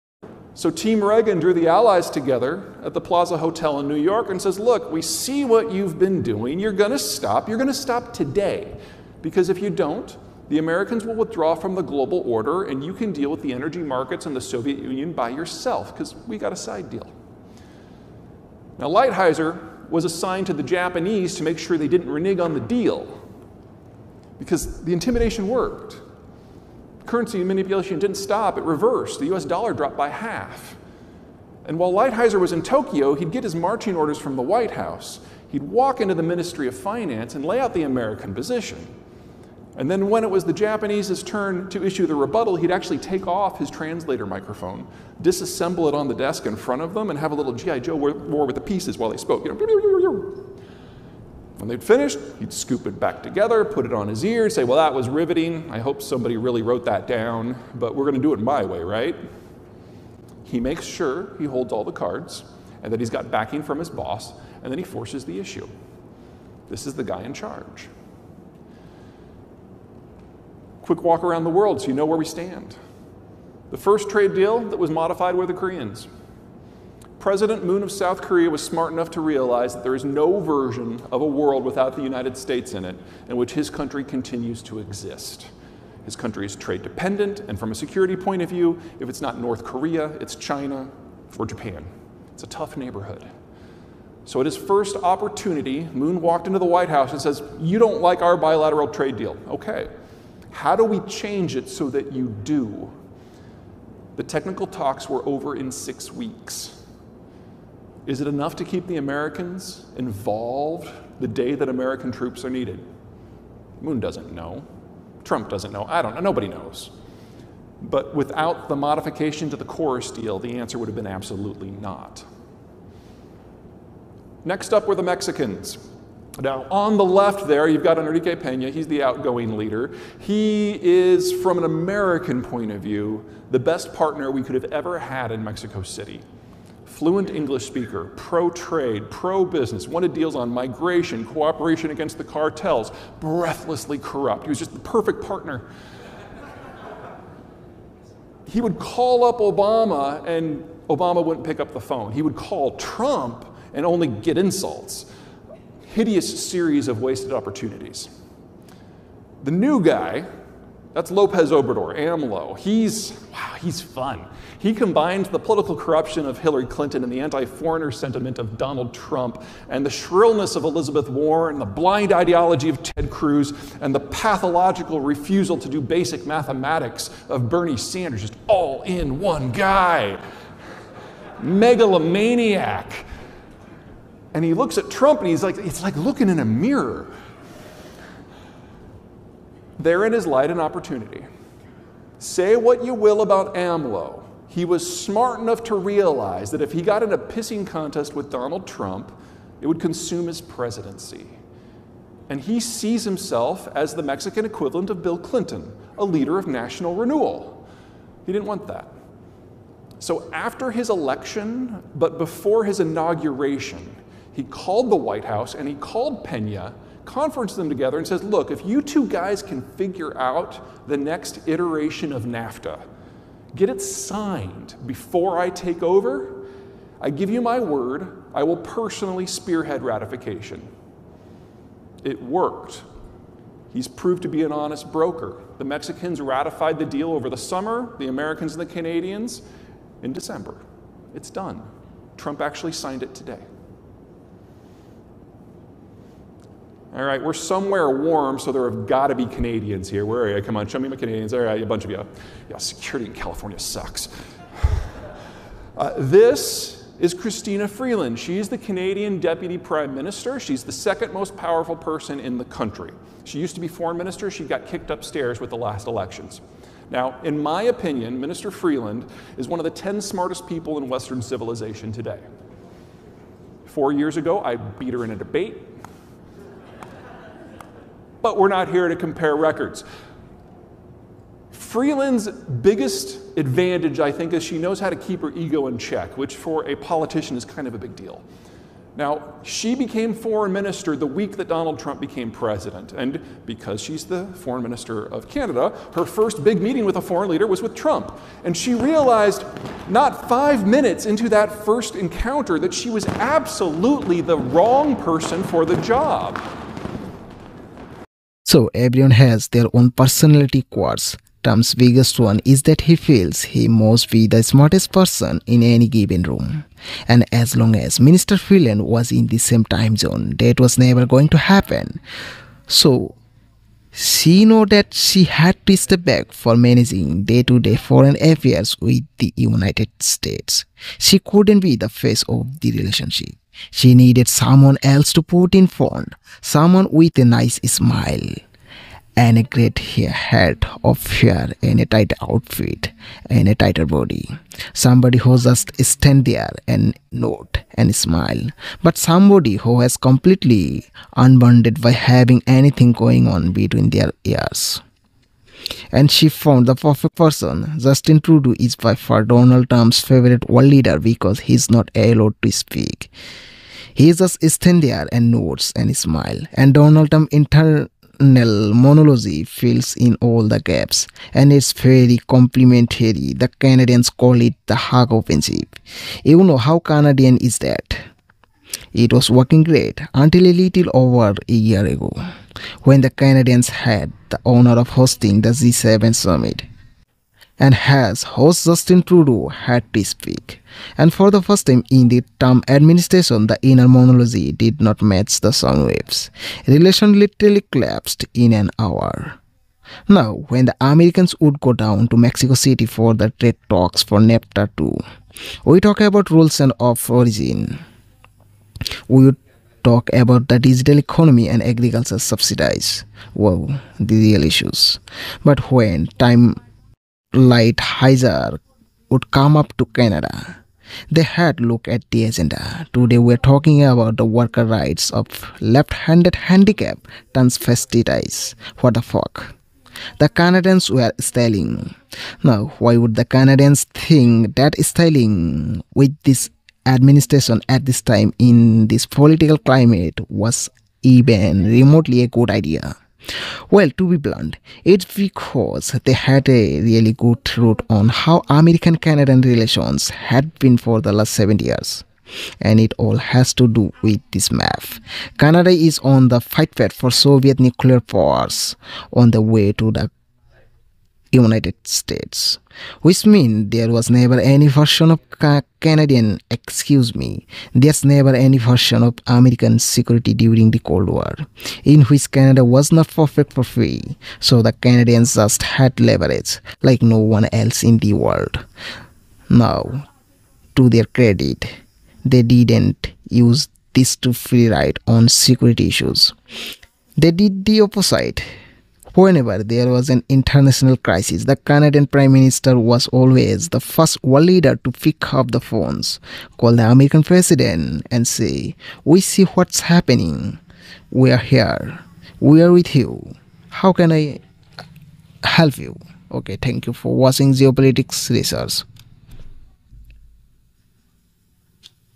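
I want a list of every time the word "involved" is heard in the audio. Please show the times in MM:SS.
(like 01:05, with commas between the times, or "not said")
01:49.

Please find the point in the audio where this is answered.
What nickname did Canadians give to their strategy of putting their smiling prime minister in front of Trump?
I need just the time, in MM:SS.
06:14.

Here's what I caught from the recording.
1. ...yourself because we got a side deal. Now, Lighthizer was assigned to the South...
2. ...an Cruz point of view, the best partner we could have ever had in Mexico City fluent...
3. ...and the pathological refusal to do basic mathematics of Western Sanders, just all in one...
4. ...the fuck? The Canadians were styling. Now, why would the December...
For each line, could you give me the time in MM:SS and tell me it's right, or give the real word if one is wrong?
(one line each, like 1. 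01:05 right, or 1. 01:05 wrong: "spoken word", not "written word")
1. 00:15 wrong: "Japanese", not "South"
2. 02:11 wrong: "American", not "Cruz"
3. 02:53 wrong: "Bernie", not "Western"
4. 07:08 wrong: "Canadians", not "December".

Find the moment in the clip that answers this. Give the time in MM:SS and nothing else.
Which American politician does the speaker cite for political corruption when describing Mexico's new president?
02:46.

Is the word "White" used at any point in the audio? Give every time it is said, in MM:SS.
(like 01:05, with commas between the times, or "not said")
00:34, 01:36, 03:34.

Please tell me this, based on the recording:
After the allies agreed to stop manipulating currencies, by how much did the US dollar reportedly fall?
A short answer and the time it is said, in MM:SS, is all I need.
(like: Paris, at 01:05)
by half, at 00:29.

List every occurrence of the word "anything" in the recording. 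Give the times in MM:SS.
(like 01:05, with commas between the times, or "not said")
05:52.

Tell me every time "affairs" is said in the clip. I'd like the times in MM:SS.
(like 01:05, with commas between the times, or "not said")
05:28.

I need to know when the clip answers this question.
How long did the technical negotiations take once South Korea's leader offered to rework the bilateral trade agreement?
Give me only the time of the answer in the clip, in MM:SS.
01:45.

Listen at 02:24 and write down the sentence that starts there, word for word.
He was just the perfect partner.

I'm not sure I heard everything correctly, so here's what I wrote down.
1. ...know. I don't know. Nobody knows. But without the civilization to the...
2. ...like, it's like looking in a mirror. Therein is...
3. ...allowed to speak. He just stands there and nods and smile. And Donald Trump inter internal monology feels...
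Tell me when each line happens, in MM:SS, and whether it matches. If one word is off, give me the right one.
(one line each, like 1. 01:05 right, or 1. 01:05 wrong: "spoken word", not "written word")
1. 01:55 wrong: "modification", not "civilization"
2. 03:05 right
3. 06:01 wrong: "fills", not "feels".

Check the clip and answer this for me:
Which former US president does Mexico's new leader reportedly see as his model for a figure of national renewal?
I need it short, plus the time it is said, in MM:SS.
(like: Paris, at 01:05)
Bill Clinton, at 03:25.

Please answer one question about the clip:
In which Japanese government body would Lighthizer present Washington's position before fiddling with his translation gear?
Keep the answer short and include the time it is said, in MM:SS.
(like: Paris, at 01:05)
Ministry of Finance, at 00:36.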